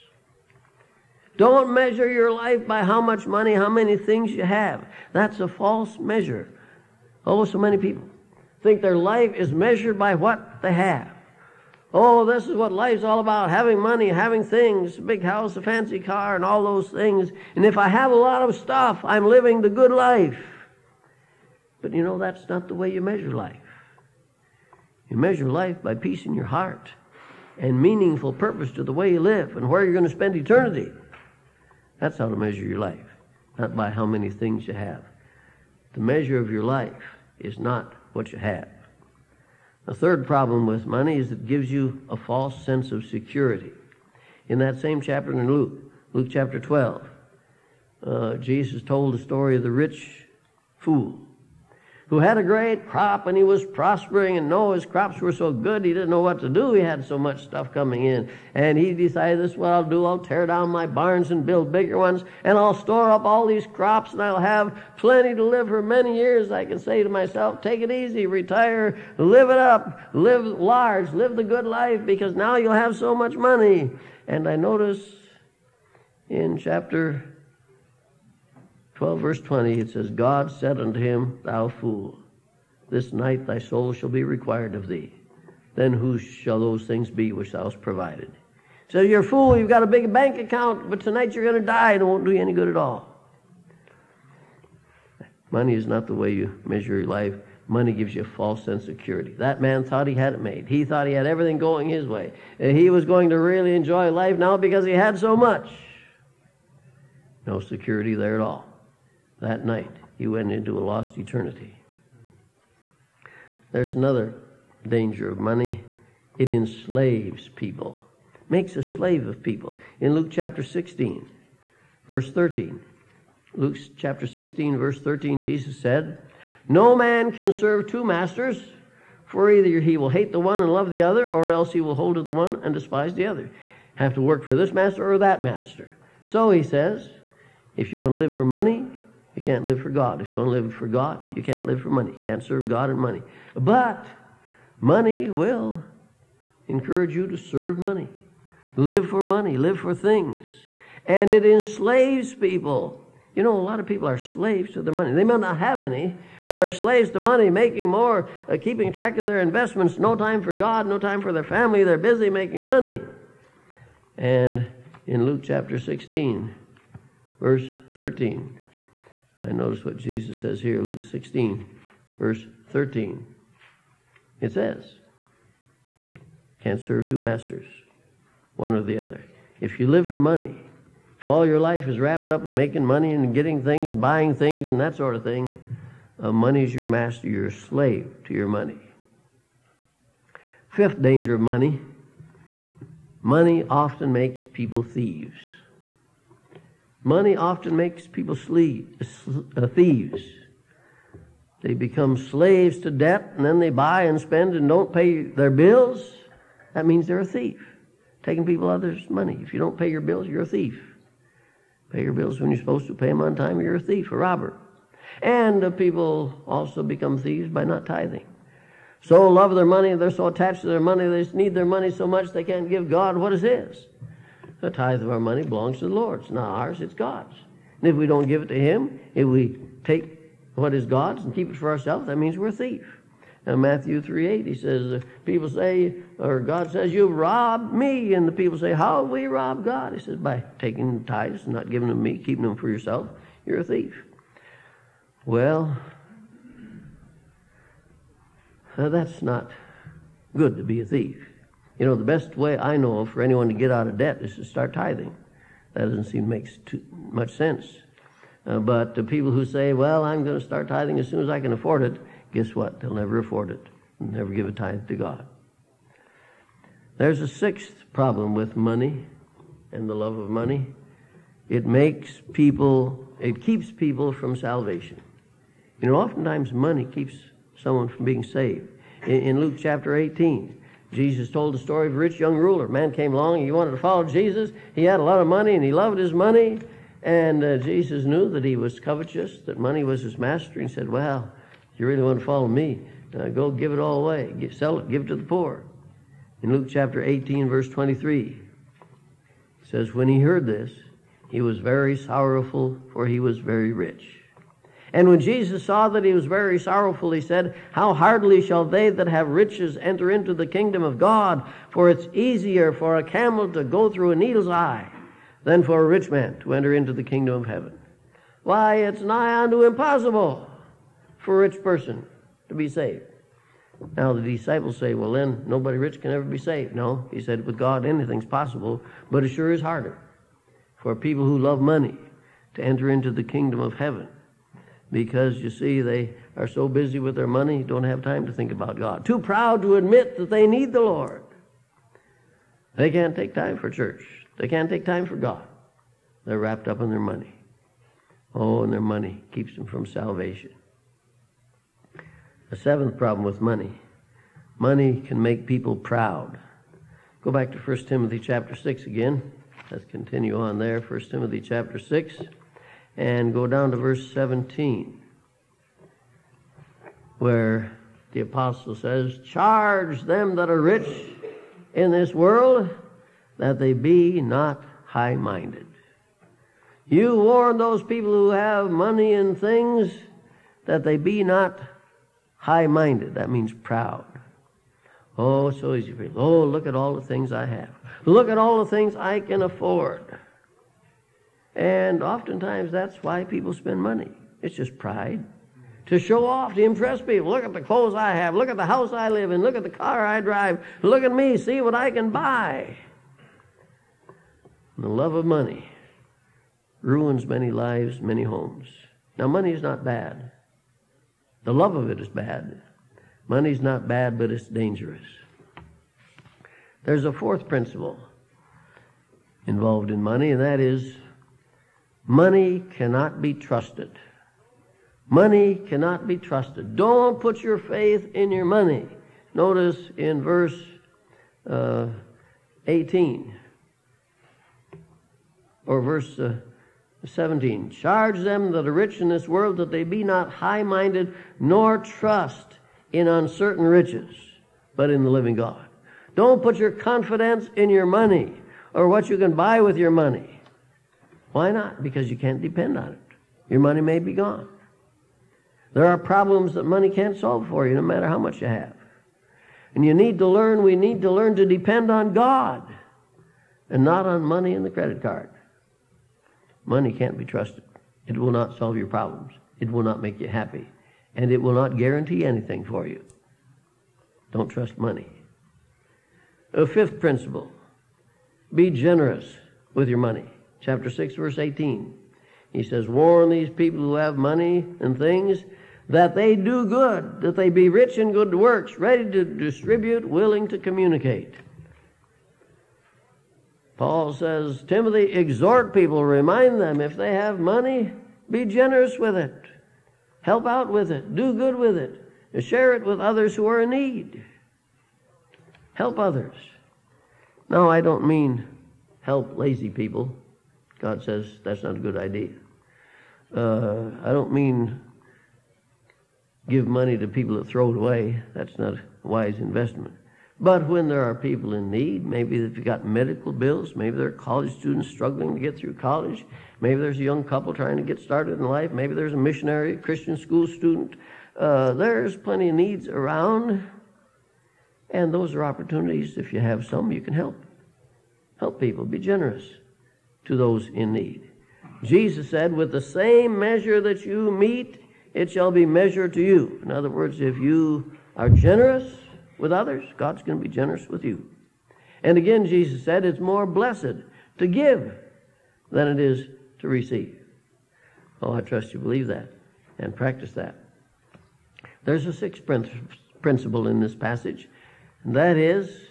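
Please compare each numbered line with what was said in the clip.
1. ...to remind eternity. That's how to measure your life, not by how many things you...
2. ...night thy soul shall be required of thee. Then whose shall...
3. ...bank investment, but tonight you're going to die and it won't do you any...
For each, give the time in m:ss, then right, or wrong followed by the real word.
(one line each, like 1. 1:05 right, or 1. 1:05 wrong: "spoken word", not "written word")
1. 0:30 wrong: "spend", not "remind"
2. 1:23 right
3. 1:30 wrong: "account", not "investment".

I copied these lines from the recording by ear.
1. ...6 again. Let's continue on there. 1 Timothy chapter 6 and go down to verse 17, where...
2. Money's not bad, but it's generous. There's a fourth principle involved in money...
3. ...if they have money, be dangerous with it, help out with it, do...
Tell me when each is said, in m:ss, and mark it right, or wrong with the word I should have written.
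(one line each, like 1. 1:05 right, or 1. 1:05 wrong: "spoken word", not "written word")
1. 5:58 right
2. 6:53 wrong: "dangerous", not "generous"
3. 8:16 wrong: "generous", not "dangerous".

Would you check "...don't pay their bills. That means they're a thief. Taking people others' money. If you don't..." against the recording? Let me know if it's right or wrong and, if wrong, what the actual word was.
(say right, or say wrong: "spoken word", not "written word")
right.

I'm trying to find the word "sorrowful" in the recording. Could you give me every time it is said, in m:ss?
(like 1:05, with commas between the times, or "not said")
5:01, 5:06.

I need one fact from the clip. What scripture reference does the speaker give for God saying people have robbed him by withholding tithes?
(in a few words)
Matthew 3:8.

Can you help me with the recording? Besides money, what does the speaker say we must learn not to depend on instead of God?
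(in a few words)
the credit card.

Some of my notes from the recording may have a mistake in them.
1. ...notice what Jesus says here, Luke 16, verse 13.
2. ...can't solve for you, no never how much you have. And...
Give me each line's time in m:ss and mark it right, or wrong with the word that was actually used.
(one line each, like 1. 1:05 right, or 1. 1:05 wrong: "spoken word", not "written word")
1. 2:49 right
2. 7:36 wrong: "matter", not "never".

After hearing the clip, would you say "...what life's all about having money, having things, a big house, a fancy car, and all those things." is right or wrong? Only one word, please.
right.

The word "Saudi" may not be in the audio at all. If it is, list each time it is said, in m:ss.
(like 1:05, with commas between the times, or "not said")
not said.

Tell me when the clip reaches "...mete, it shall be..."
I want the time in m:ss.
9:04.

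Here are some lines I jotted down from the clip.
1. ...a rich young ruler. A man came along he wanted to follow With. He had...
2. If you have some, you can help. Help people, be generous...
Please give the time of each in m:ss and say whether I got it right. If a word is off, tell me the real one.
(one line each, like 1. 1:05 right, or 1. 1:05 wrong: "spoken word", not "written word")
1. 4:41 wrong: "Jesus", not "With"
2. 8:56 right.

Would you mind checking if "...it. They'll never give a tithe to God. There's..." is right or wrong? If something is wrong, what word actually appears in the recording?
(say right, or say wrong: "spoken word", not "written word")
right.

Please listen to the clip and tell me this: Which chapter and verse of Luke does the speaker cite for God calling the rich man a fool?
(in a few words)
Chapter 12, verse 20.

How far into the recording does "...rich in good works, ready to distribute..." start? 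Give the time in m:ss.
8:07.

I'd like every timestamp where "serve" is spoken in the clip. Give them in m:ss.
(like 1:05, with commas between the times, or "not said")
2:07, 2:22, 2:27, 2:56.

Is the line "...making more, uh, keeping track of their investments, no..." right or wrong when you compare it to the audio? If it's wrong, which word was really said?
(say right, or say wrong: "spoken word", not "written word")
right.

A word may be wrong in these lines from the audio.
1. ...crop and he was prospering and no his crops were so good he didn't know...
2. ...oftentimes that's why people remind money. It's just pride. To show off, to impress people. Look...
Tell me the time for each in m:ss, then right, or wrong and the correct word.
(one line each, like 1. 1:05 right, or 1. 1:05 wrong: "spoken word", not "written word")
1. 0:52 right
2. 6:32 wrong: "spend", not "remind".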